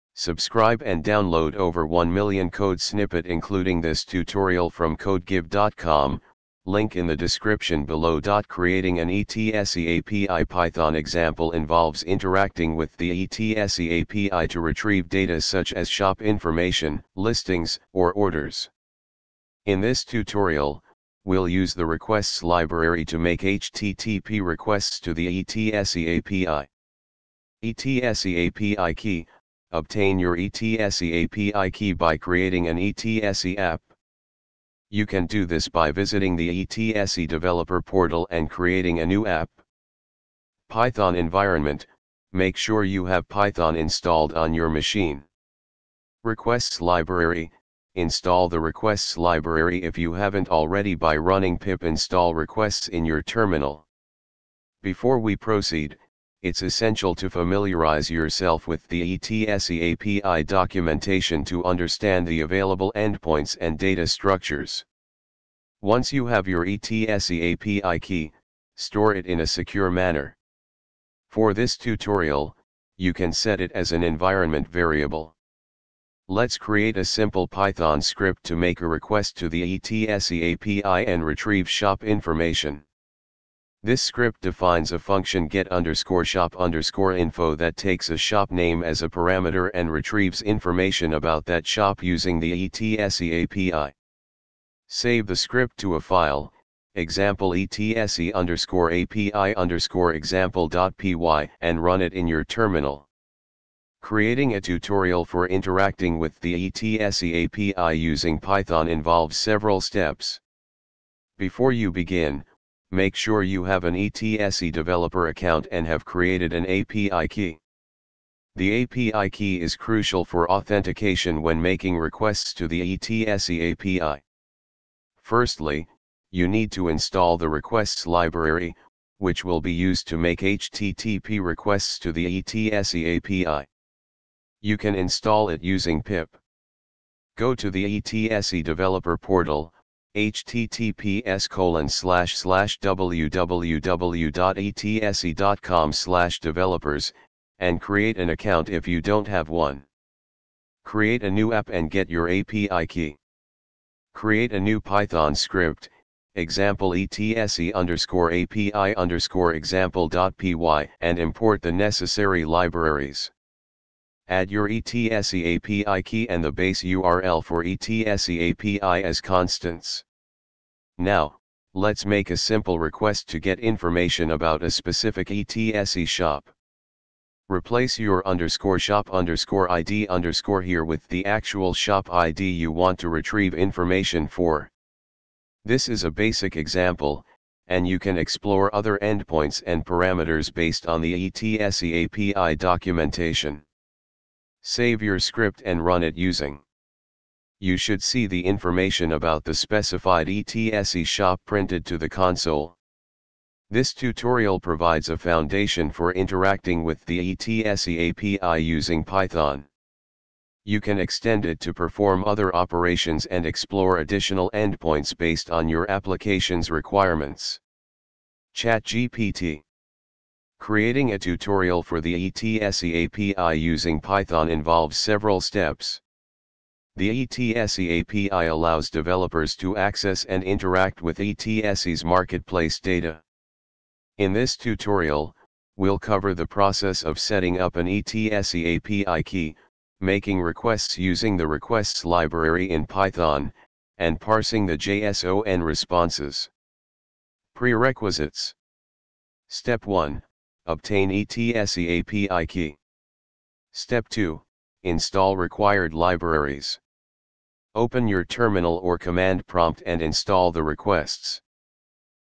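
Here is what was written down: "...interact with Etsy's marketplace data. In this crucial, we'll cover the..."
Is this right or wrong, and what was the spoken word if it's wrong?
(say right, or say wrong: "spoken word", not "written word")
wrong: "tutorial", not "crucial".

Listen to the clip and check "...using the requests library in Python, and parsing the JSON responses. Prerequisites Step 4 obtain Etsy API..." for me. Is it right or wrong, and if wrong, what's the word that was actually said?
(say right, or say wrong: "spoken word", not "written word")
wrong: "1", not "4".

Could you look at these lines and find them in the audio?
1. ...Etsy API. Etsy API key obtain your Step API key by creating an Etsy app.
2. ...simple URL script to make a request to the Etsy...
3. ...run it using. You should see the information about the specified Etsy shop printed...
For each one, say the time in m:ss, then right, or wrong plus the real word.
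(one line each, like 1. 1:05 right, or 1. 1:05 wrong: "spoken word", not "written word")
1. 0:25 wrong: "Etsy", not "Step"
2. 1:17 wrong: "Python", not "URL"
3. 3:15 right.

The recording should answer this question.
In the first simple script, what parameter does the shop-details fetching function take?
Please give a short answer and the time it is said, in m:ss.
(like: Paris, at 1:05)
shop name, at 1:28.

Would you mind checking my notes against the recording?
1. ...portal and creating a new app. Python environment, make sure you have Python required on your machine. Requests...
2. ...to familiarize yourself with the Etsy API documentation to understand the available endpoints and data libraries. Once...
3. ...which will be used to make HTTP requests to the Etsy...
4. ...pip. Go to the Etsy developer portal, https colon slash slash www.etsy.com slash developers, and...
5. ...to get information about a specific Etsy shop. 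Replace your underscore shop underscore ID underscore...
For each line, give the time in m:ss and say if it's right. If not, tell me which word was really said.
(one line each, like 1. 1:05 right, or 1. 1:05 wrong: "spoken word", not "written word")
1. 0:37 wrong: "installed", not "required"
2. 0:57 wrong: "structures", not "libraries"
3. 2:09 right
4. 2:16 right
5. 2:53 right.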